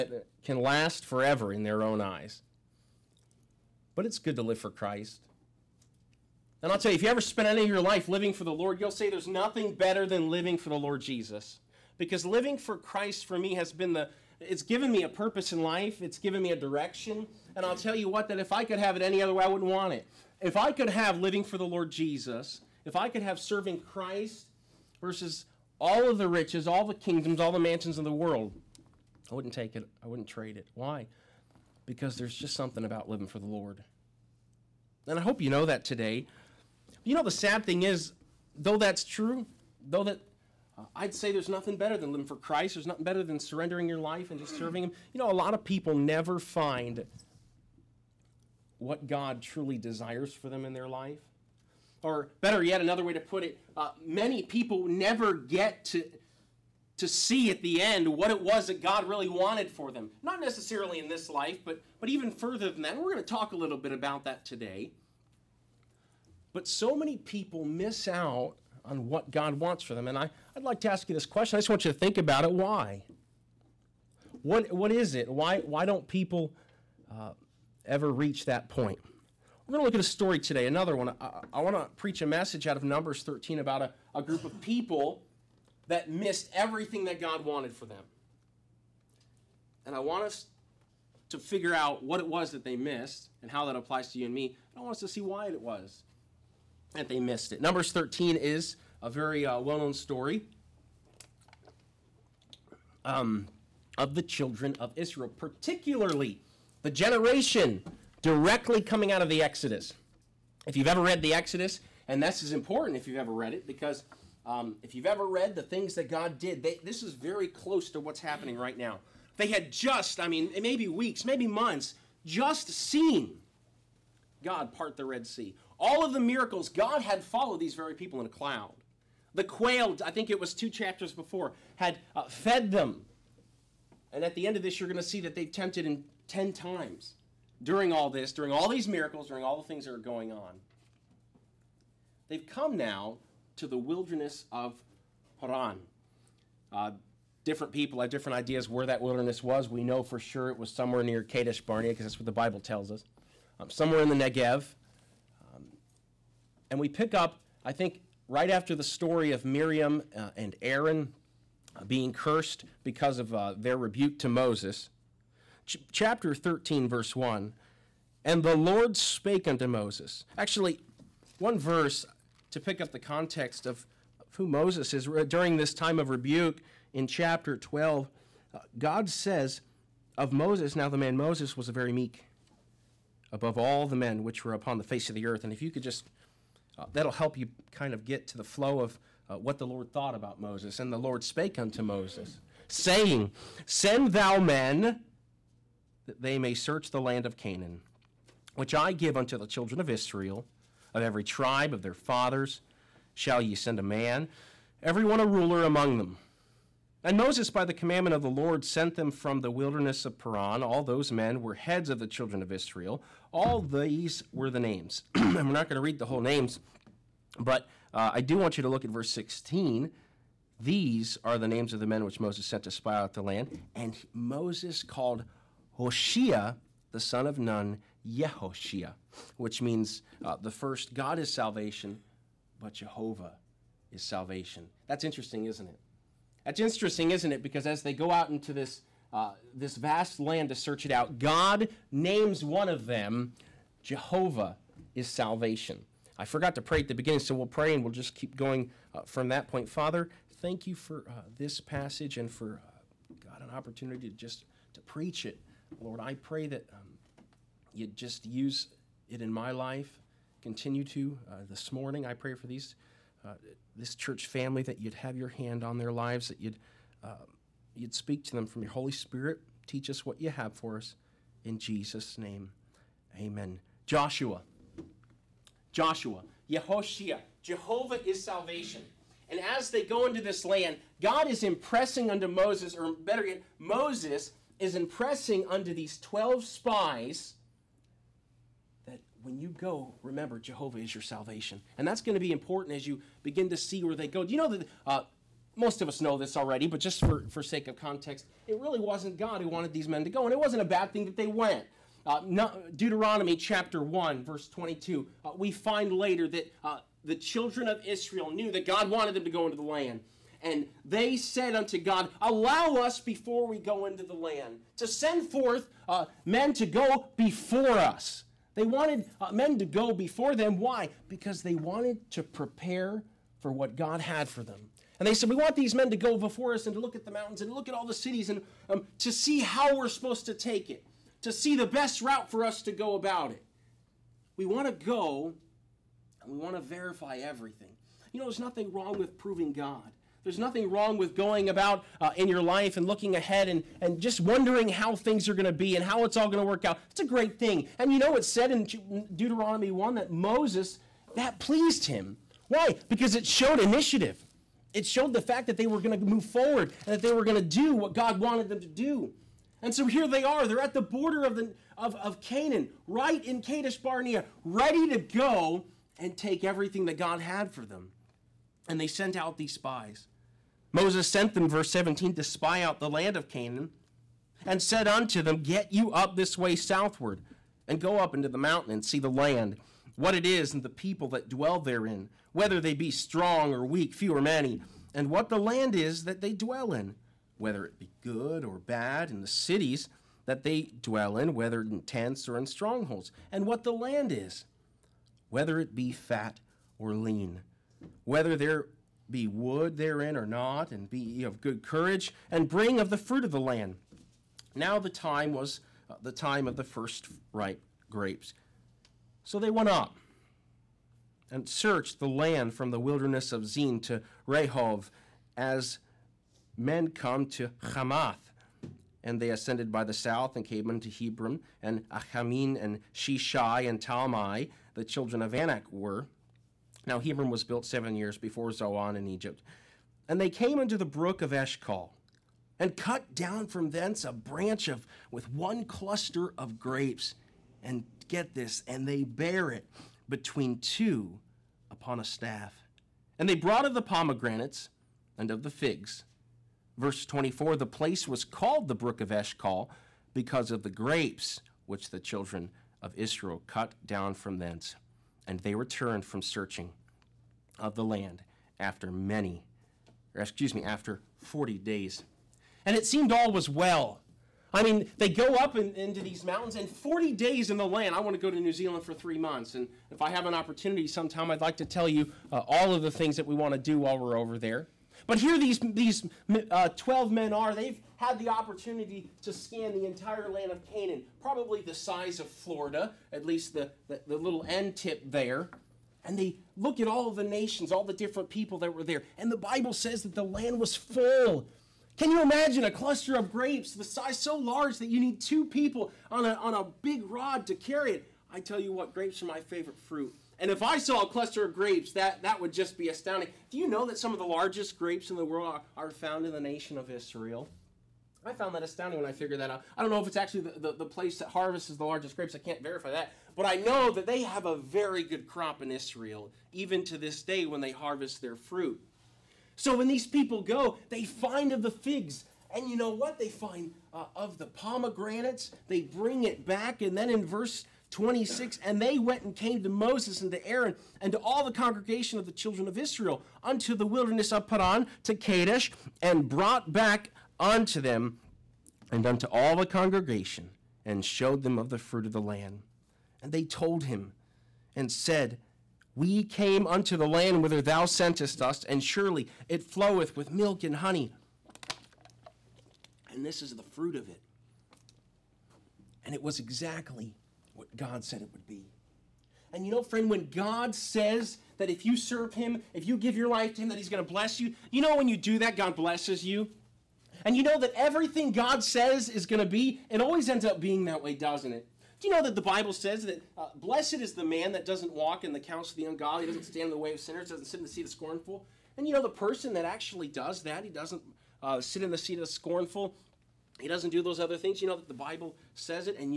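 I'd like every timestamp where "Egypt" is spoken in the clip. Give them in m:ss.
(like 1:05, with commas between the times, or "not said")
7:09.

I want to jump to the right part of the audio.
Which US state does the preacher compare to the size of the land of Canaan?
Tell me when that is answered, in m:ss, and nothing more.
8:02.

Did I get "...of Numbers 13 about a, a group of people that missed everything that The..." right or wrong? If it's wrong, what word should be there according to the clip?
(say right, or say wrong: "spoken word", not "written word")
wrong: "God", not "The".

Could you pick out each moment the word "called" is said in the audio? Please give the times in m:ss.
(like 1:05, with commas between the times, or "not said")
3:44, 7:28.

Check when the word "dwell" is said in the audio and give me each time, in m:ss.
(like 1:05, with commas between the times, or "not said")
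6:21, 6:26, 6:30.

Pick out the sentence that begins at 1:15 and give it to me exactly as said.
Why, why don't people uh, ever reach that point.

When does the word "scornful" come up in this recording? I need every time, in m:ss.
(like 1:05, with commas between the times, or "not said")
9:37, 9:42.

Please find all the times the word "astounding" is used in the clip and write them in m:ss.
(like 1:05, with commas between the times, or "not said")
8:22, 8:28.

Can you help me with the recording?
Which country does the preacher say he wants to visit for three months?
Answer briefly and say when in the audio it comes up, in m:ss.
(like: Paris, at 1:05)
New Zealand, at 7:48.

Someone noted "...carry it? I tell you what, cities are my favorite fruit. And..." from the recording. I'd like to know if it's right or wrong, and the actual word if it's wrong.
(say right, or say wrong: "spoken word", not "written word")
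wrong: "grapes", not "cities".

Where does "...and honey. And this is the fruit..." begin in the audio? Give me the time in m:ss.
9:10.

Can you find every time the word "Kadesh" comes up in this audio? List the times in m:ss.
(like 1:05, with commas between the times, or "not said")
2:31, 6:03, 8:55.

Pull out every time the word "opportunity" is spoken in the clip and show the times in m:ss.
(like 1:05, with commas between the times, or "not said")
4:13, 7:50, 7:58.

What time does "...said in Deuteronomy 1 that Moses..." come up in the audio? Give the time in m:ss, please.
5:48.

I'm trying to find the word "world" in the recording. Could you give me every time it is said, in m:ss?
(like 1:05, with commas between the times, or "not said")
0:28, 8:25.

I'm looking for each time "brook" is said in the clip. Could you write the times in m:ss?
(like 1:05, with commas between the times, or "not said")
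7:10, 7:28.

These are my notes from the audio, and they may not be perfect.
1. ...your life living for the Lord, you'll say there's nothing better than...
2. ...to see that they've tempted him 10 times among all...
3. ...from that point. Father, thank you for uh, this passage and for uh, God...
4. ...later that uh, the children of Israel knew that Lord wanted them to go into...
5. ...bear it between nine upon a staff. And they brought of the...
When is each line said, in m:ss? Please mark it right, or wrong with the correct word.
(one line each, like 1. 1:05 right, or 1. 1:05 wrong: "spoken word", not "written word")
1. 0:07 right
2. 2:14 wrong: "during", not "among"
3. 4:09 right
4. 5:05 wrong: "God", not "Lord"
5. 7:19 wrong: "two", not "nine".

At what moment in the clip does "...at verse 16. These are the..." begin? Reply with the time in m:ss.
3:38.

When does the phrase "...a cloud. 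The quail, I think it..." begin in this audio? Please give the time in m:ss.
2:08.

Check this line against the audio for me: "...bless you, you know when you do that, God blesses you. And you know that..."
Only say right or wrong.
right.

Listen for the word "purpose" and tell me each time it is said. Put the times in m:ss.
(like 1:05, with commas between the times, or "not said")
0:15.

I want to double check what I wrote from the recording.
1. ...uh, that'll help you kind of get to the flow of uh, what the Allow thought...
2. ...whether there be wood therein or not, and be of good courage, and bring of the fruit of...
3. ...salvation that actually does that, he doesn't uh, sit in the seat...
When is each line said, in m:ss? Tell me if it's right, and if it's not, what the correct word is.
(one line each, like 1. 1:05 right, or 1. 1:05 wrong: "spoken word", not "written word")
1. 3:06 wrong: "Lord", not "Allow"
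2. 6:38 right
3. 9:39 wrong: "person", not "salvation".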